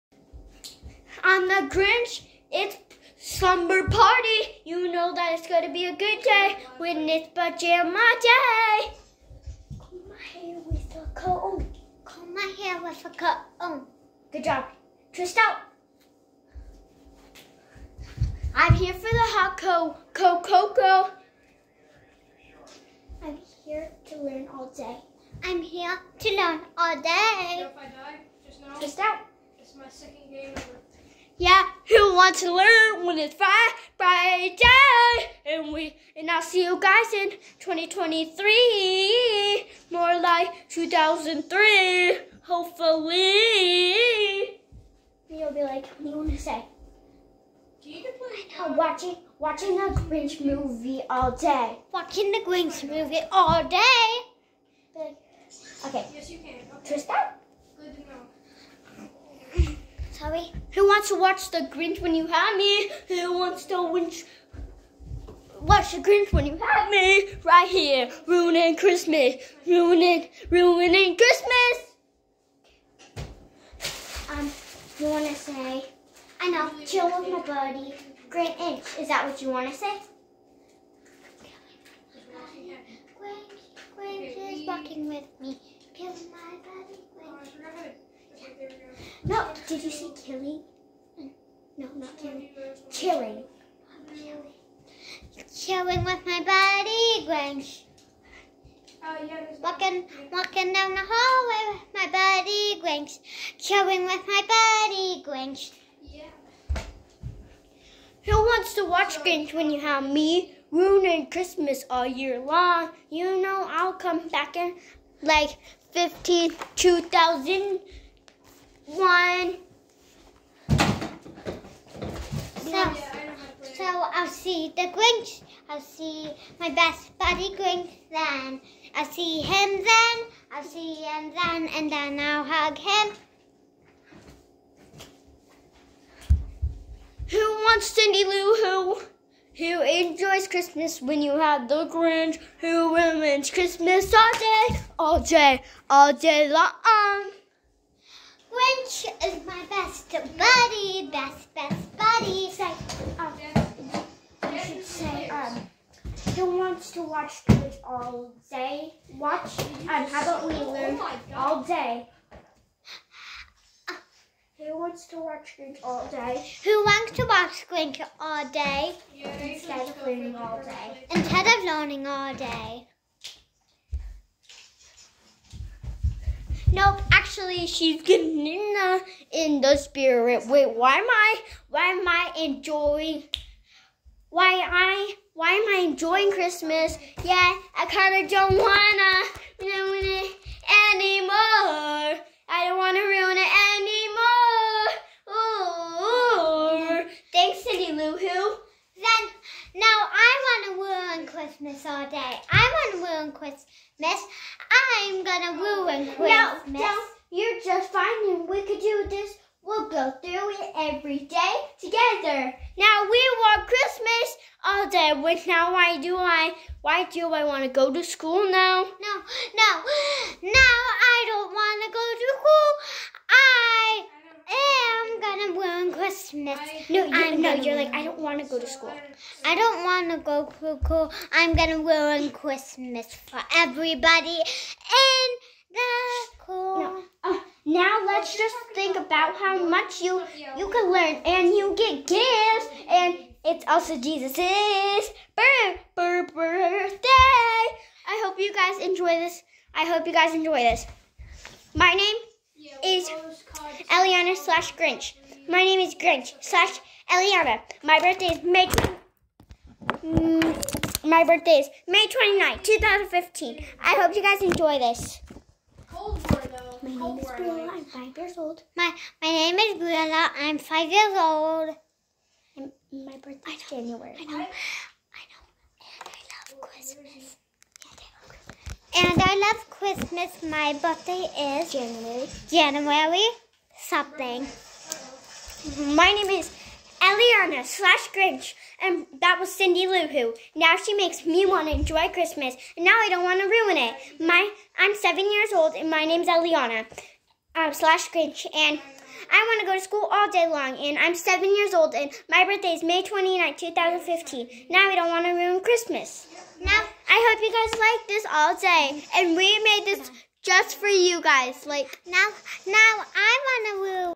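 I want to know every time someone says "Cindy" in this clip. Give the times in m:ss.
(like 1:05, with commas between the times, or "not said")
2:17, 3:17, 4:49.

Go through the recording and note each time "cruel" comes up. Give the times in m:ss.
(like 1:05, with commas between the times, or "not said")
not said.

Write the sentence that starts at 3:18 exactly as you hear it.
Then now I wanna ruin Christmas all day.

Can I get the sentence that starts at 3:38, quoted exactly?
No, no, no, I don't want to go to school.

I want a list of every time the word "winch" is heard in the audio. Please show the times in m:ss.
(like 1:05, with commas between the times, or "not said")
1:03.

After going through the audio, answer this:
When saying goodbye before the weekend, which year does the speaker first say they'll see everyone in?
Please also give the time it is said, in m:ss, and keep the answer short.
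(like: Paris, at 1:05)
2023, at 0:37.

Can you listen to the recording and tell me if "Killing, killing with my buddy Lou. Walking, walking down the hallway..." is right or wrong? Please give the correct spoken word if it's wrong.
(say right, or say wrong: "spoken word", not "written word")
wrong: "Grinch", not "Lou".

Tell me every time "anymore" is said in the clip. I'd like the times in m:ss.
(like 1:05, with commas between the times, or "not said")
3:10, 3:17.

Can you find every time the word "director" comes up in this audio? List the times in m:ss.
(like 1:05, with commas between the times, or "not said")
not said.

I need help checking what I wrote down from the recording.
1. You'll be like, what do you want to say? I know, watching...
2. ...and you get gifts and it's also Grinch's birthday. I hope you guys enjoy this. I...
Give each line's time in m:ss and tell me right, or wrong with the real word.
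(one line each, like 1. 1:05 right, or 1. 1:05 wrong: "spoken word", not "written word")
1. 0:45 right
2. 4:01 wrong: "Jesus", not "Grinch".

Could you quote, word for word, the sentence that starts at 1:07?
Right here, ruining Christmas, ruining, ruining Christmas.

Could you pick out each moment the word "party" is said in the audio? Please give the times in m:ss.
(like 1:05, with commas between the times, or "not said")
0:03.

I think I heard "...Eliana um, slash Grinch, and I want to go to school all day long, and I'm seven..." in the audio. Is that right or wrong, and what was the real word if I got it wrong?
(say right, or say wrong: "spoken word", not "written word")
right.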